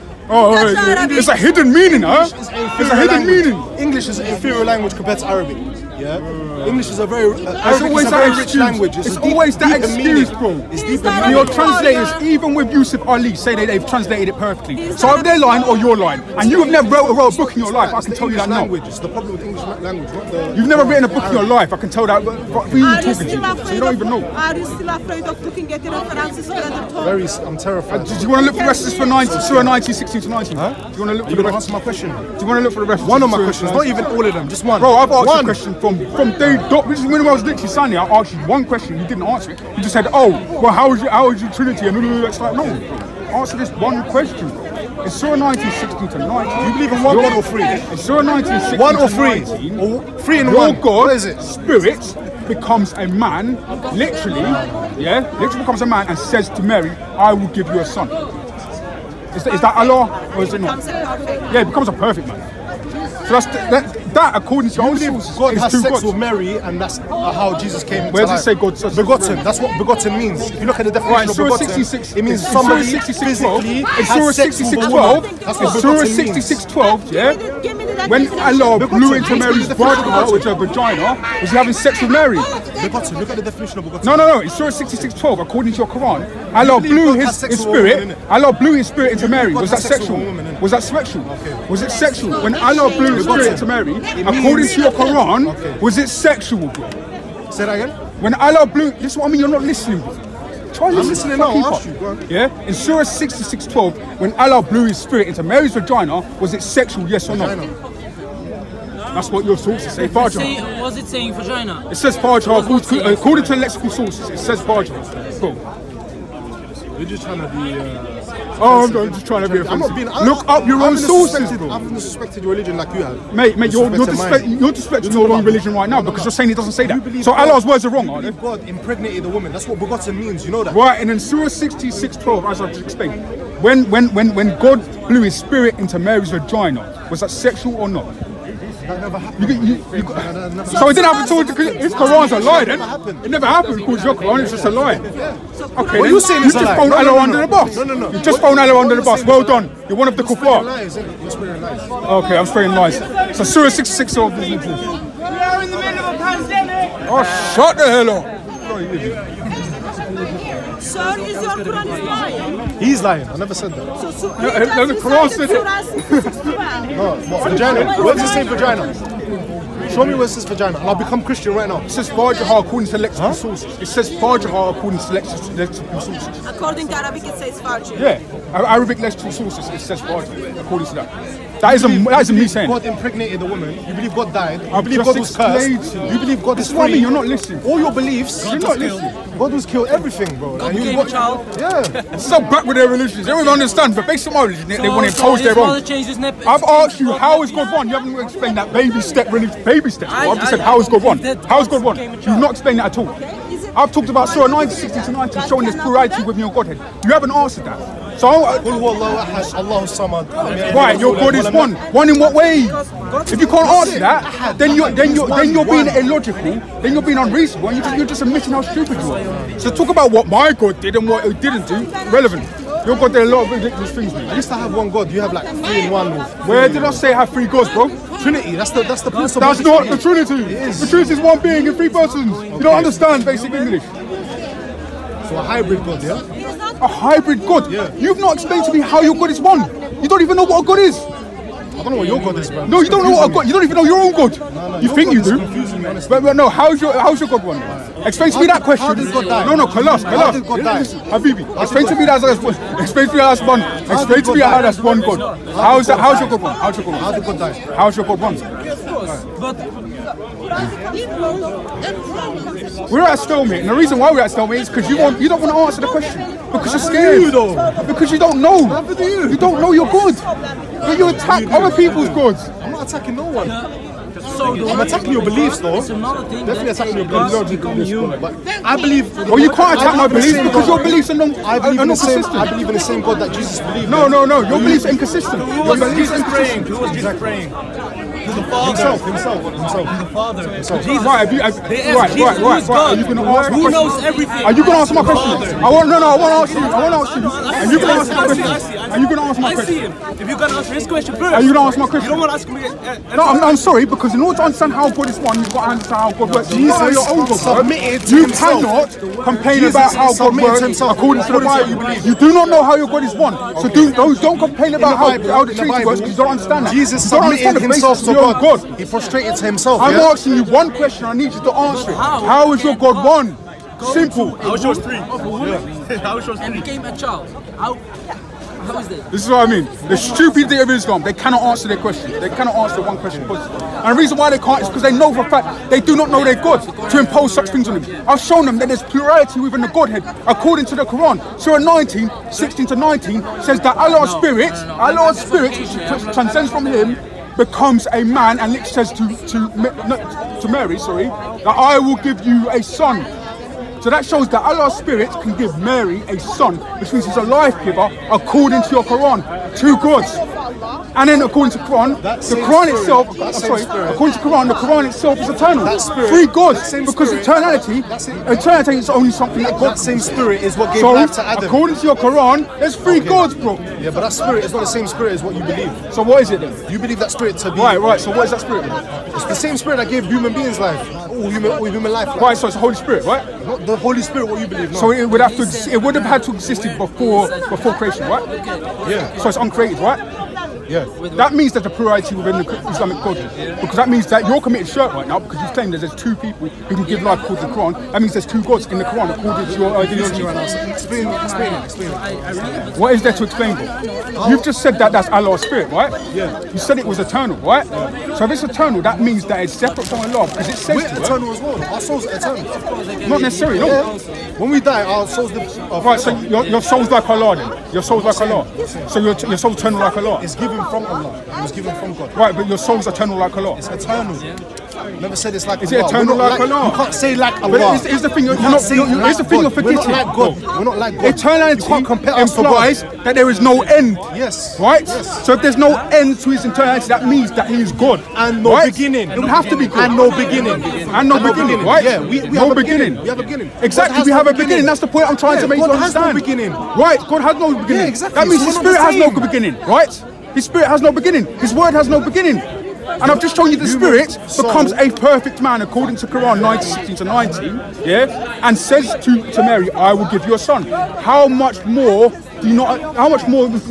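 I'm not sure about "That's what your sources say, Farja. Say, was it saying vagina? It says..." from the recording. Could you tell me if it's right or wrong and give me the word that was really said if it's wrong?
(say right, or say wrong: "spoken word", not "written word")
right.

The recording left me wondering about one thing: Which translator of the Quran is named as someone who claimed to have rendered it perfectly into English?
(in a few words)
Yusuf Ali.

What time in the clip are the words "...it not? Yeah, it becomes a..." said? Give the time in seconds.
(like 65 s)
60 s.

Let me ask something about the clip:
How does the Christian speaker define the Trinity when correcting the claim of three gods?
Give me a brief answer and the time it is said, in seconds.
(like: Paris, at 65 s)
One being in three persons, at 231 s.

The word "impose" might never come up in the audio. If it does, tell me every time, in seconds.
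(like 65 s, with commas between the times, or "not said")
195 s, 336 s.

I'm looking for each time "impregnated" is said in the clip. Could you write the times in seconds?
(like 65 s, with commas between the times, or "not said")
128 s, 182 s.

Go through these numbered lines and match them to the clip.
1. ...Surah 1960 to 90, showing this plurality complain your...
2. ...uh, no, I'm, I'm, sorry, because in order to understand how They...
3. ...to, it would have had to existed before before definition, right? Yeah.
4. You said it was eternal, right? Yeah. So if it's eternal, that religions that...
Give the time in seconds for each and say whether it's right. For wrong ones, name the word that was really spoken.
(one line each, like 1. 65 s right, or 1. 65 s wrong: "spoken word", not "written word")
1. 204 s wrong: "within", not "complain"
2. 303 s wrong: "God", not "They"
3. 385 s wrong: "creation", not "definition"
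4. 406 s wrong: "means", not "religions".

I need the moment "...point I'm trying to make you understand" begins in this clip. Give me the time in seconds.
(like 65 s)
444 s.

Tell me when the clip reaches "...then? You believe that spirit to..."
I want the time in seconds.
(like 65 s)
376 s.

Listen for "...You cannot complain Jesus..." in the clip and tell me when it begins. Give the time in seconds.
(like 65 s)
308 s.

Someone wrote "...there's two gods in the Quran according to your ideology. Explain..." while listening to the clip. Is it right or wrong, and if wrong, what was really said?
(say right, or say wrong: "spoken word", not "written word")
right.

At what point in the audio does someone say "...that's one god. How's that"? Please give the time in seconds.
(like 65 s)
254 s.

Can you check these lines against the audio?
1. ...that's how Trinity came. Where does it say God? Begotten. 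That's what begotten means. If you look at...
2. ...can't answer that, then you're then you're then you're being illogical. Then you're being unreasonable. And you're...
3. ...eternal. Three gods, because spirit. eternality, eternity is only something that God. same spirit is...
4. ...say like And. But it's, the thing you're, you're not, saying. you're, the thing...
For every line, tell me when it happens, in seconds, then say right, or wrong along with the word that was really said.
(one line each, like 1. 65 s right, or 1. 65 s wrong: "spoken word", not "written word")
1. 66 s wrong: "Jesus", not "Trinity"
2. 213 s right
3. 365 s right
4. 426 s wrong: "Allah", not "And".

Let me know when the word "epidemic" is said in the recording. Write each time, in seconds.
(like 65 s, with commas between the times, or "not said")
not said.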